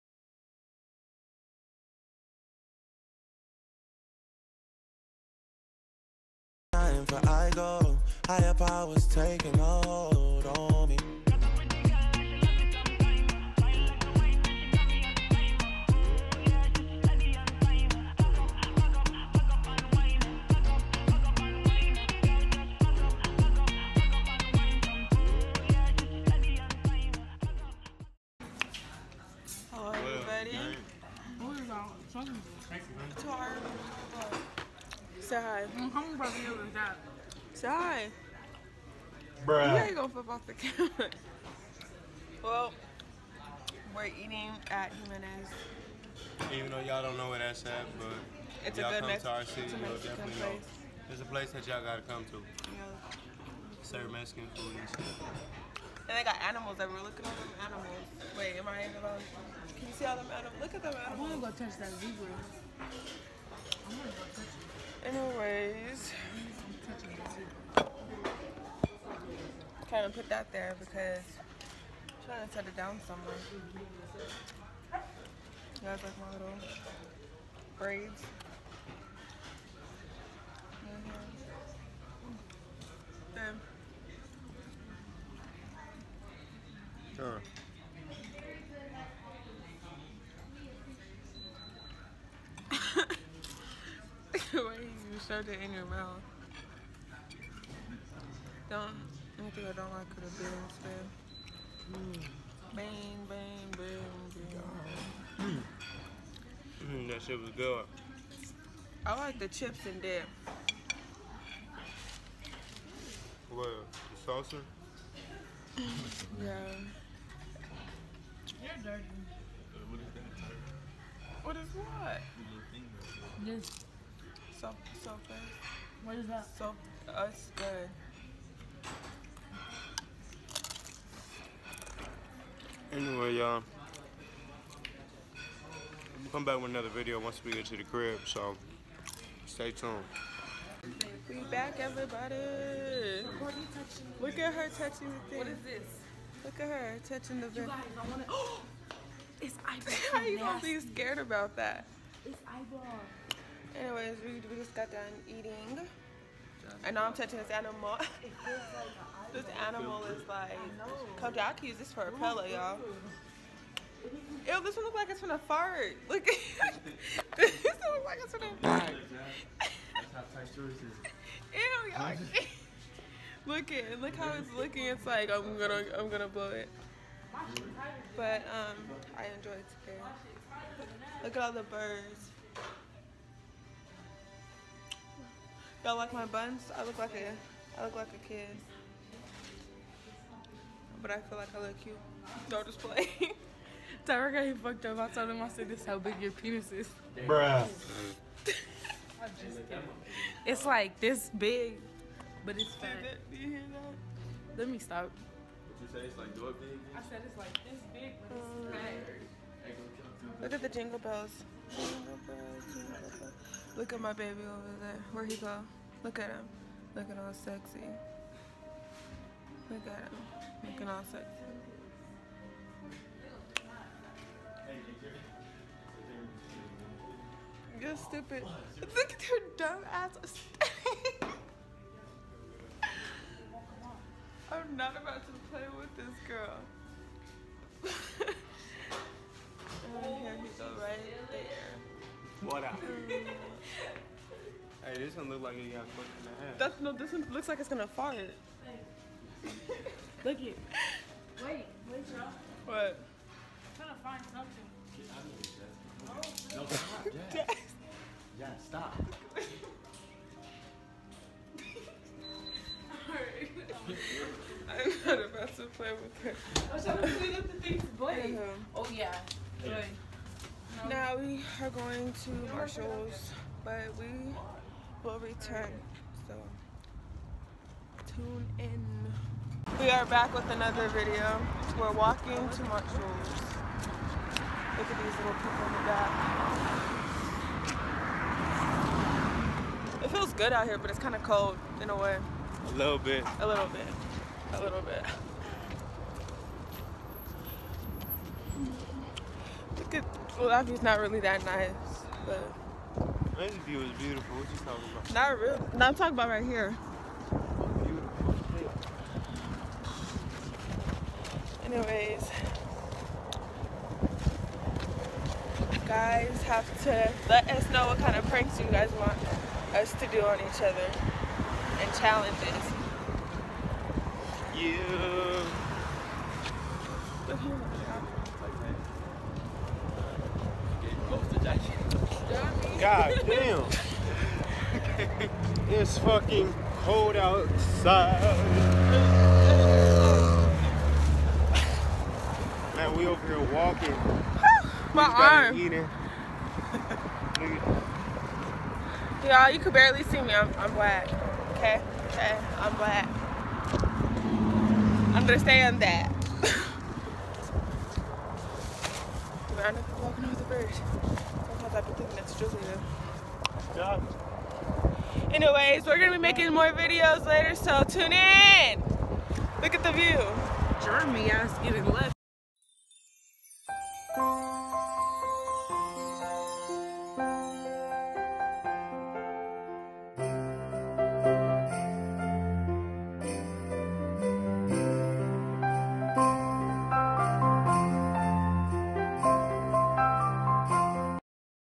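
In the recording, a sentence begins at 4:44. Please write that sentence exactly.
Look at these little people in the back.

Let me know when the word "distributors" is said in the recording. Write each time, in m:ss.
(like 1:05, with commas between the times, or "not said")
not said.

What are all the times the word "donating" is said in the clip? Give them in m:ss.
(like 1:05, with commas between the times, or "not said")
not said.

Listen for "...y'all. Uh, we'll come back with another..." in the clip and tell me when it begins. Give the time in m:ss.
2:13.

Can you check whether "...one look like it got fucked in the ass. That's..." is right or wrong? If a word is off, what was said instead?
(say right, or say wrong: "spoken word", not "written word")
right.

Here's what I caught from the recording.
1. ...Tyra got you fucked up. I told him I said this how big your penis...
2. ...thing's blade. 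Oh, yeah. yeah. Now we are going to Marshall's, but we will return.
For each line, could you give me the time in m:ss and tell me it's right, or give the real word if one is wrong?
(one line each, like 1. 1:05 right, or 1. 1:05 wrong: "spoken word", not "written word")
1. 3:14 right
2. 4:27 right.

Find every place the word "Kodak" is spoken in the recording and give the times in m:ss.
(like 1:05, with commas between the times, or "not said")
2:41.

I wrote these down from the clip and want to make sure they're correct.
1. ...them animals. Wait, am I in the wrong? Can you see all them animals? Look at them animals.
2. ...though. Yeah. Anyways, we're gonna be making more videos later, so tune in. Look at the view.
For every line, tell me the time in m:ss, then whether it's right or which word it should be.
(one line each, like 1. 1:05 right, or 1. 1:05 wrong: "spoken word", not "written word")
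1. 0:57 right
2. 6:03 right.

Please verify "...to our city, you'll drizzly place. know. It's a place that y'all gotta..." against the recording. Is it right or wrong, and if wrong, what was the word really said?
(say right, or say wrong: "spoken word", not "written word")
wrong: "definitely", not "drizzly".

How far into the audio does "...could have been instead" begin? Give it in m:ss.
1:40.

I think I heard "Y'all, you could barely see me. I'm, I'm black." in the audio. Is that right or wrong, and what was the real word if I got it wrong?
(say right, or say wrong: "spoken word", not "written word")
right.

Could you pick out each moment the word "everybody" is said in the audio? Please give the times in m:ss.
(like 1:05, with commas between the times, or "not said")
2:21.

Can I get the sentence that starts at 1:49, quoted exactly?
I like the chips in there.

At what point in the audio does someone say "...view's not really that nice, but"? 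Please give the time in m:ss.
5:00.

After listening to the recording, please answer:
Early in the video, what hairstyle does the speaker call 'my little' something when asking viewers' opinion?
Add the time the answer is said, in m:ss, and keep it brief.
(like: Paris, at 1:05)
braids, at 1:17.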